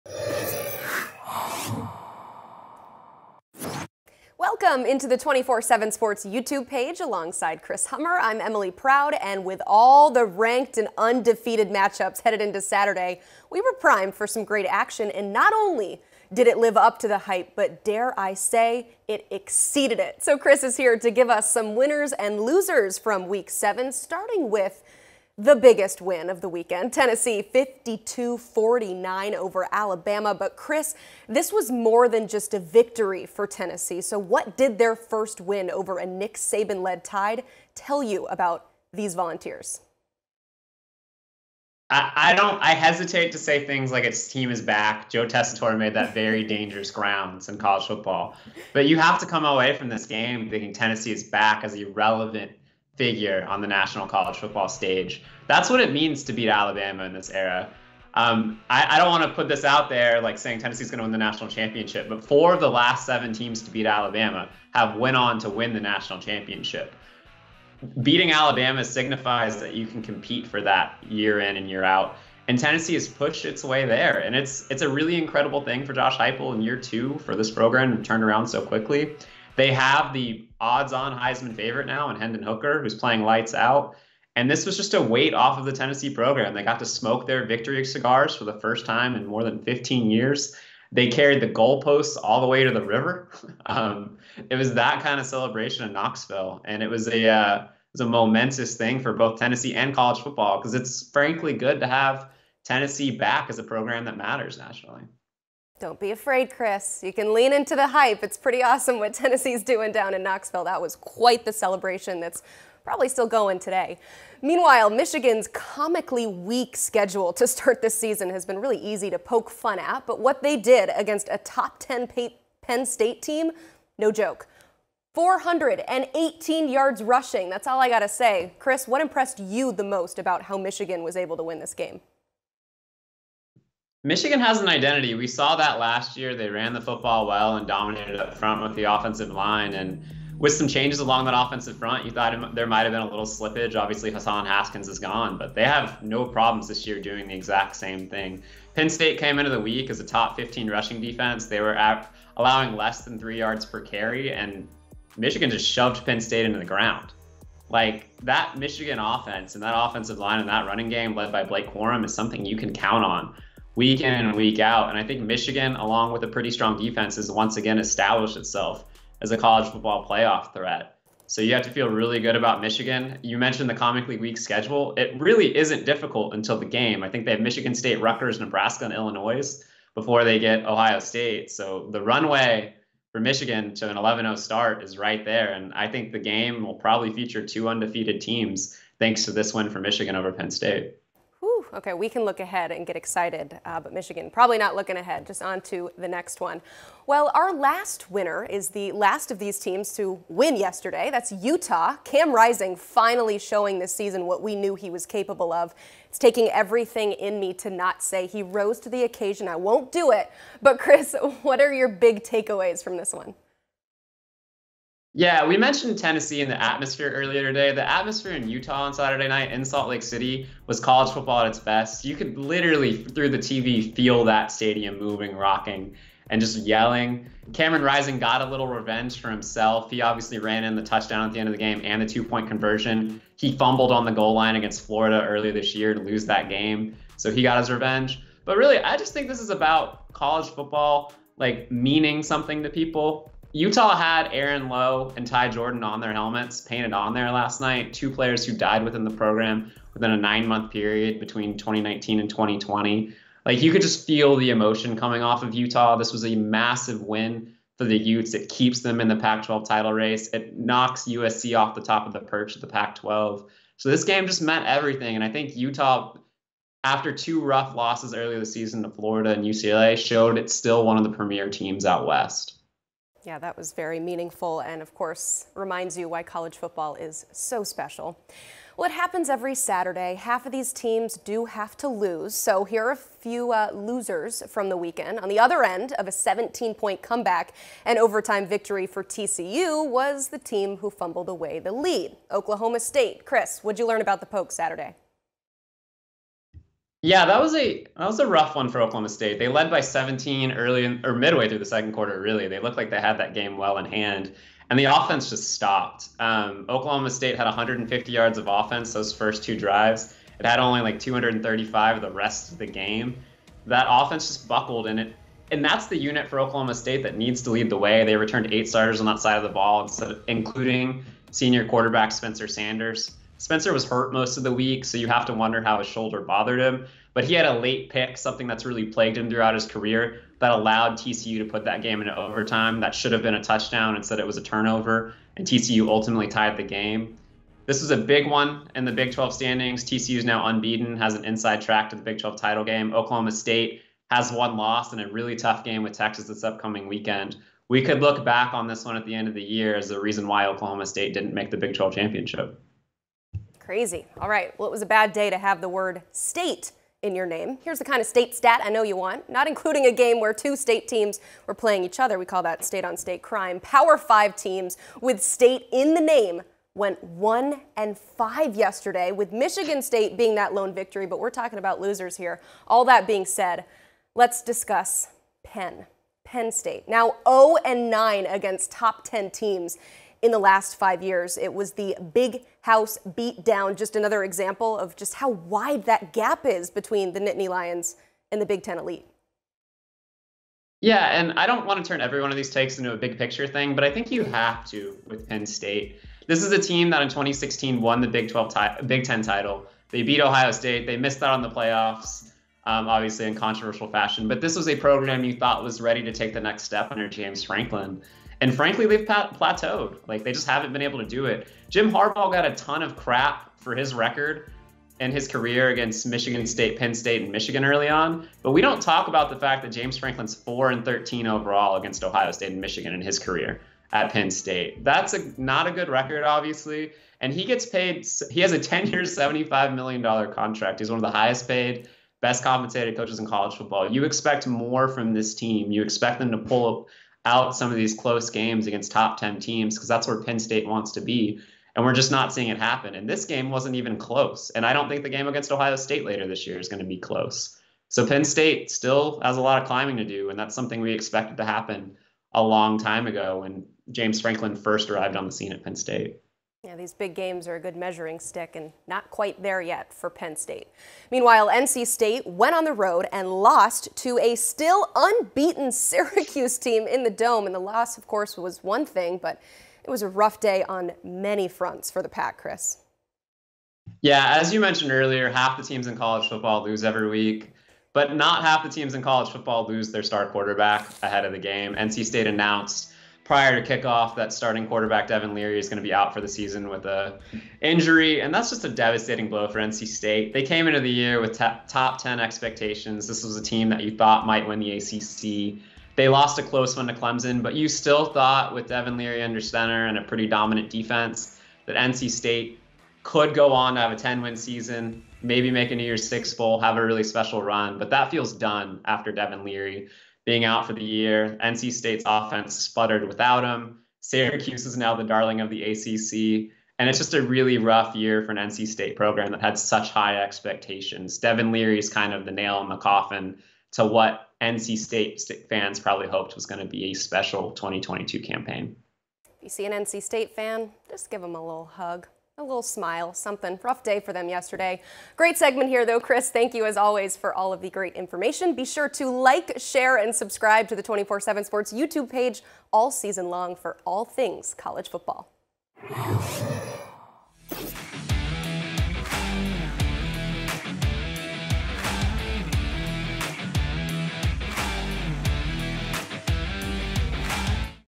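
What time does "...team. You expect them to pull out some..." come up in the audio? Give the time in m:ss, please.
7:15.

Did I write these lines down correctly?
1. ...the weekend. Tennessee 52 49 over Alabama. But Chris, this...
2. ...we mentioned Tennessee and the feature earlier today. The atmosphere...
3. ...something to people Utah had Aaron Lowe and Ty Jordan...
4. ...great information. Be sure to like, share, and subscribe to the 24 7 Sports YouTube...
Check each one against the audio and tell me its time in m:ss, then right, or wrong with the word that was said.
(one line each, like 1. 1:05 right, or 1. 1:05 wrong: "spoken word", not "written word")
1. 0:26 right
2. 3:35 wrong: "atmosphere", not "feature"
3. 4:02 right
4. 8:57 right.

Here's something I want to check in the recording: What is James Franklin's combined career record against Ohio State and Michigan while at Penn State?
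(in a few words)
4 and 13.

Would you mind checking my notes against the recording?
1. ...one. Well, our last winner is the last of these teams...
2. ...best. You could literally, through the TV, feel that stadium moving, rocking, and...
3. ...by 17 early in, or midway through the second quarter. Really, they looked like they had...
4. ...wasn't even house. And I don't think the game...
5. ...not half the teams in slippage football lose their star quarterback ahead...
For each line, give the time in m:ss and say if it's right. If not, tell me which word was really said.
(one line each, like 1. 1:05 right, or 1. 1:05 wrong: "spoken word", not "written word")
1. 3:16 right
2. 3:41 right
3. 4:59 right
4. 7:23 wrong: "close", not "house"
5. 7:58 wrong: "college", not "slippage".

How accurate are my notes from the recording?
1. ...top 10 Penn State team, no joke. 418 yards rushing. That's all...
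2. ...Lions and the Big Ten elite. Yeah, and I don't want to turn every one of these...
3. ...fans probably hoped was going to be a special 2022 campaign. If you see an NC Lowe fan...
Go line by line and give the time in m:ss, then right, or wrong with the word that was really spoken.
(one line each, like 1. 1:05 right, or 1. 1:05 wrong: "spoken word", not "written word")
1. 2:01 right
2. 6:27 right
3. 8:45 wrong: "State", not "Lowe".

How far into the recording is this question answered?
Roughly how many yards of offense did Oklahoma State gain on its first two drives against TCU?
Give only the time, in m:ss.
5:07.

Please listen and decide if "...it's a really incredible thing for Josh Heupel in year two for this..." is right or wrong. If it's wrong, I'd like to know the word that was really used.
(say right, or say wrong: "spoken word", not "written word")
right.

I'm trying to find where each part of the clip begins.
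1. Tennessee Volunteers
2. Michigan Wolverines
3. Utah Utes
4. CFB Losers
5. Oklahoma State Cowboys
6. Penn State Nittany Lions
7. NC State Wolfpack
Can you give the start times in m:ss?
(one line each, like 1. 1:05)
1. 0:25
2. 1:55
3. 3:20
4. 4:40
5. 4:58
6. 6:13
7. 7:42.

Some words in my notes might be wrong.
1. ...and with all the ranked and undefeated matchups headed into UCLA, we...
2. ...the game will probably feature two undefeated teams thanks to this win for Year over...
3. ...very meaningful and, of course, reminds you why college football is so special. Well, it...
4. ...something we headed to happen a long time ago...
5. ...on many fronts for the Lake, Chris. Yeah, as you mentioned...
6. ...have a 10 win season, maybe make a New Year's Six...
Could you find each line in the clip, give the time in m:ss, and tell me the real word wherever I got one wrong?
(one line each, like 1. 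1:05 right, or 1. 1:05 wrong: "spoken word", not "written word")
1. 0:09 wrong: "Saturday", not "UCLA"
2. 3:06 wrong: "Michigan", not "Year"
3. 4:33 right
4. 7:30 wrong: "expected", not "headed"
5. 7:50 wrong: "Pack", not "Lake"
6. 8:23 right.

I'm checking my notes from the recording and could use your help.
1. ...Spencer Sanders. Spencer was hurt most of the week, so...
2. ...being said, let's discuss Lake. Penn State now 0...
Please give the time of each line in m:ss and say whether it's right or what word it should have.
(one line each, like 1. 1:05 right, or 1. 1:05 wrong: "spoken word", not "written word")
1. 5:22 right
2. 6:13 wrong: "Penn", not "Lake".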